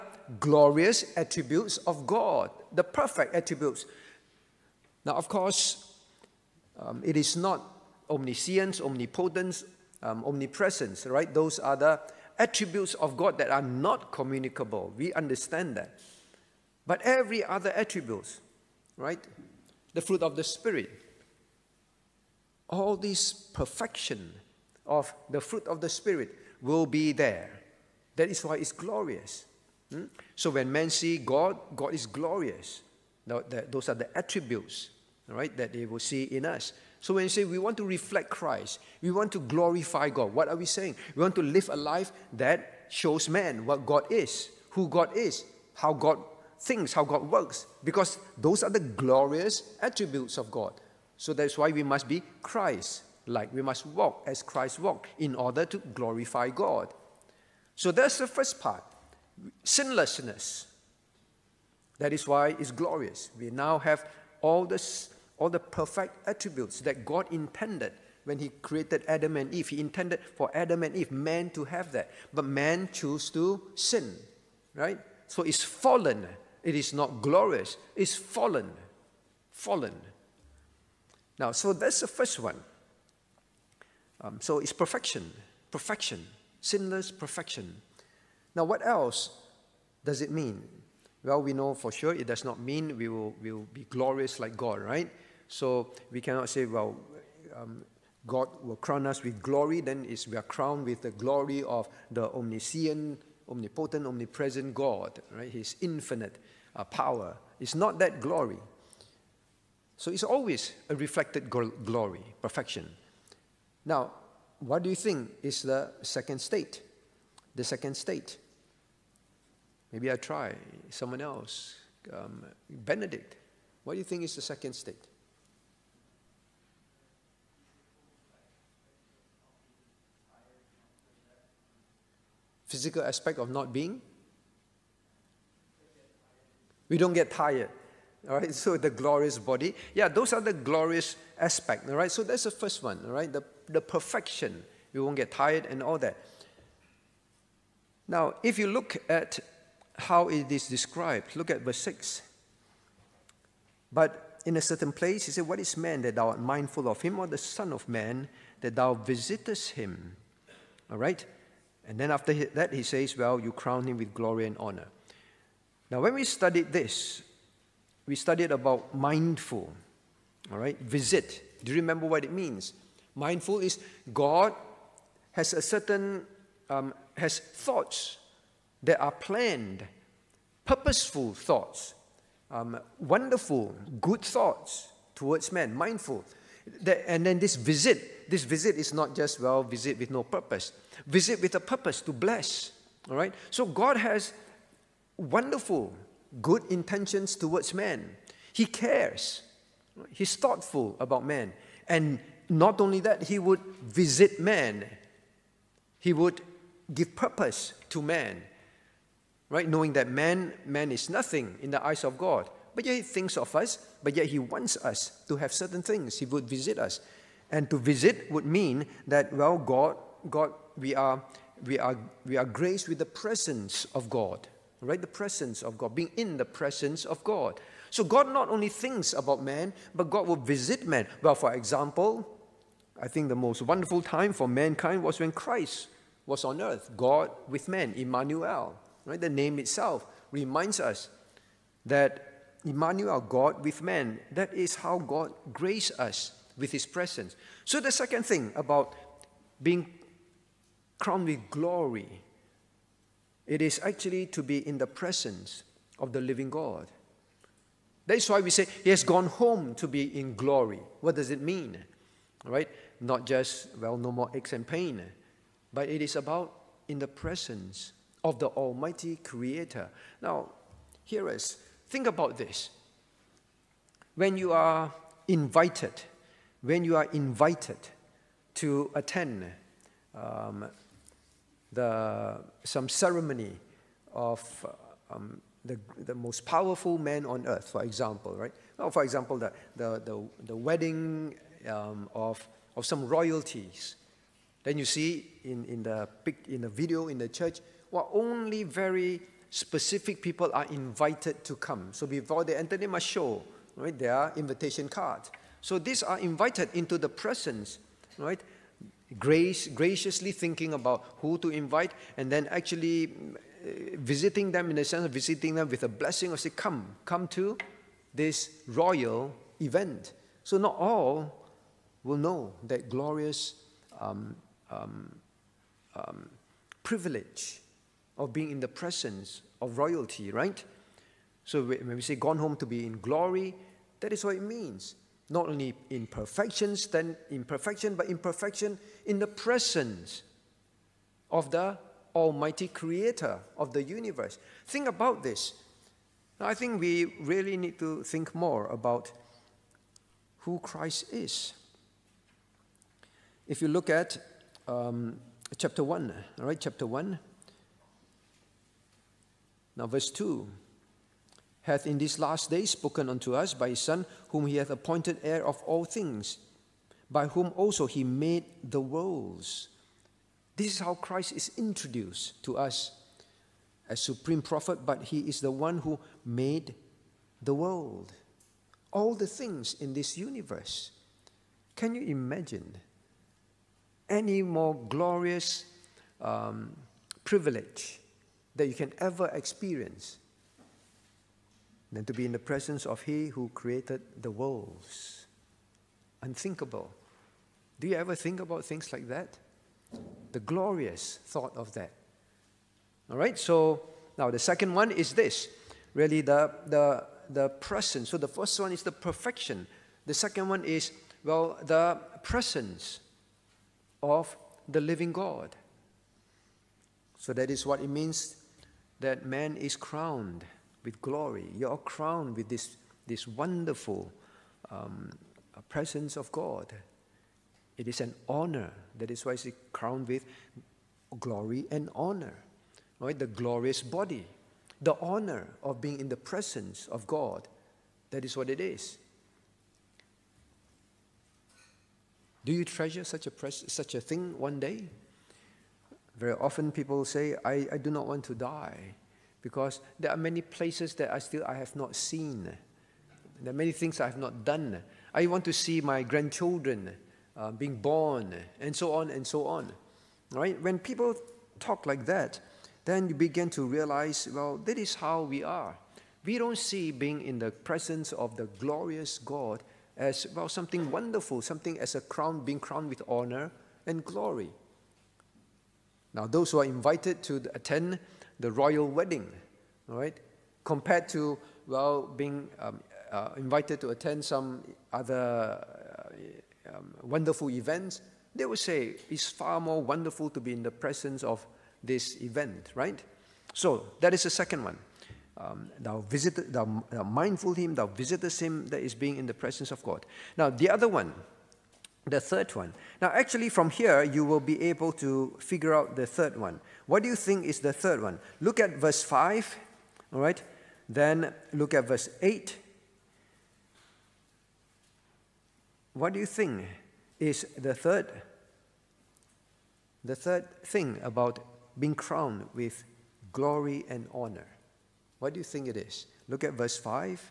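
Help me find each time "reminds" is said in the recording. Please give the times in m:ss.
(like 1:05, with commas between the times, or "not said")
4:00.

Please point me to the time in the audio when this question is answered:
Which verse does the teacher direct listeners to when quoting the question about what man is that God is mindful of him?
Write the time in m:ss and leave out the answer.
2:31.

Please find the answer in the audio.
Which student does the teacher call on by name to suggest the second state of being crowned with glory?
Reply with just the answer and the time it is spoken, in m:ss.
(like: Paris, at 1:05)
Benedict, at 2:02.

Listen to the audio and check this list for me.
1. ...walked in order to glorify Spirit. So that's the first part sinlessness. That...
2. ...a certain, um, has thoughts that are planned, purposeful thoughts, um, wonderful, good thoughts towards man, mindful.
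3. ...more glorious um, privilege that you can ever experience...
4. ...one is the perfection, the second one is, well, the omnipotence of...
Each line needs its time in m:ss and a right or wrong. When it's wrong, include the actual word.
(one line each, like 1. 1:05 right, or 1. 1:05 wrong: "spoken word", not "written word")
1. 0:54 wrong: "God", not "Spirit"
2. 2:55 right
3. 6:24 right
4. 6:48 wrong: "presence", not "omnipotence".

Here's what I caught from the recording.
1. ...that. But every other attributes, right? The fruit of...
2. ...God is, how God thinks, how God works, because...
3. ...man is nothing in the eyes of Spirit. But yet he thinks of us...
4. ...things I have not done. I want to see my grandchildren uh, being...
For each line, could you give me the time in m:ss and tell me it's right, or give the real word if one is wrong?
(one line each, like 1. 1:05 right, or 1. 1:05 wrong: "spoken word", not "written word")
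1. 0:15 right
2. 0:44 right
3. 3:30 wrong: "God", not "Spirit"
4. 7:33 right.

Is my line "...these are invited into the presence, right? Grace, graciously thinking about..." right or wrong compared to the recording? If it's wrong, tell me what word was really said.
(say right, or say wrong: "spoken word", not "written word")
right.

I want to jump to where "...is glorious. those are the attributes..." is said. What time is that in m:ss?
0:31.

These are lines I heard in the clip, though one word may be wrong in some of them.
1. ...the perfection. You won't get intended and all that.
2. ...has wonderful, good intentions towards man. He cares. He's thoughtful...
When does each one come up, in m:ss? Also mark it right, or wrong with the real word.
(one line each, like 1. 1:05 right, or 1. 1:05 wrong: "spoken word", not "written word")
1. 2:23 wrong: "tired", not "intended"
2. 3:13 right.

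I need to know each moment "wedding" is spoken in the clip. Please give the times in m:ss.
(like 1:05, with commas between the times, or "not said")
4:50, 7:58.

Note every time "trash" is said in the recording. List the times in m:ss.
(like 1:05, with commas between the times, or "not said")
not said.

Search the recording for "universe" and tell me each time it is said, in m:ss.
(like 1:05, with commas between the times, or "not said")
5:43, 6:20.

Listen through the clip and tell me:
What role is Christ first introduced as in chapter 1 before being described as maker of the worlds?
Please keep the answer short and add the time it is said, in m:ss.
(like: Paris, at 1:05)
Supreme prophet, at 6:13.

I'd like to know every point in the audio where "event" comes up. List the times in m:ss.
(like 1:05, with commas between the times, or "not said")
5:19, 8:07, 8:12.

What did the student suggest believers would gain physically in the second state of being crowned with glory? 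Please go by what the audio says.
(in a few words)
We don't get tired.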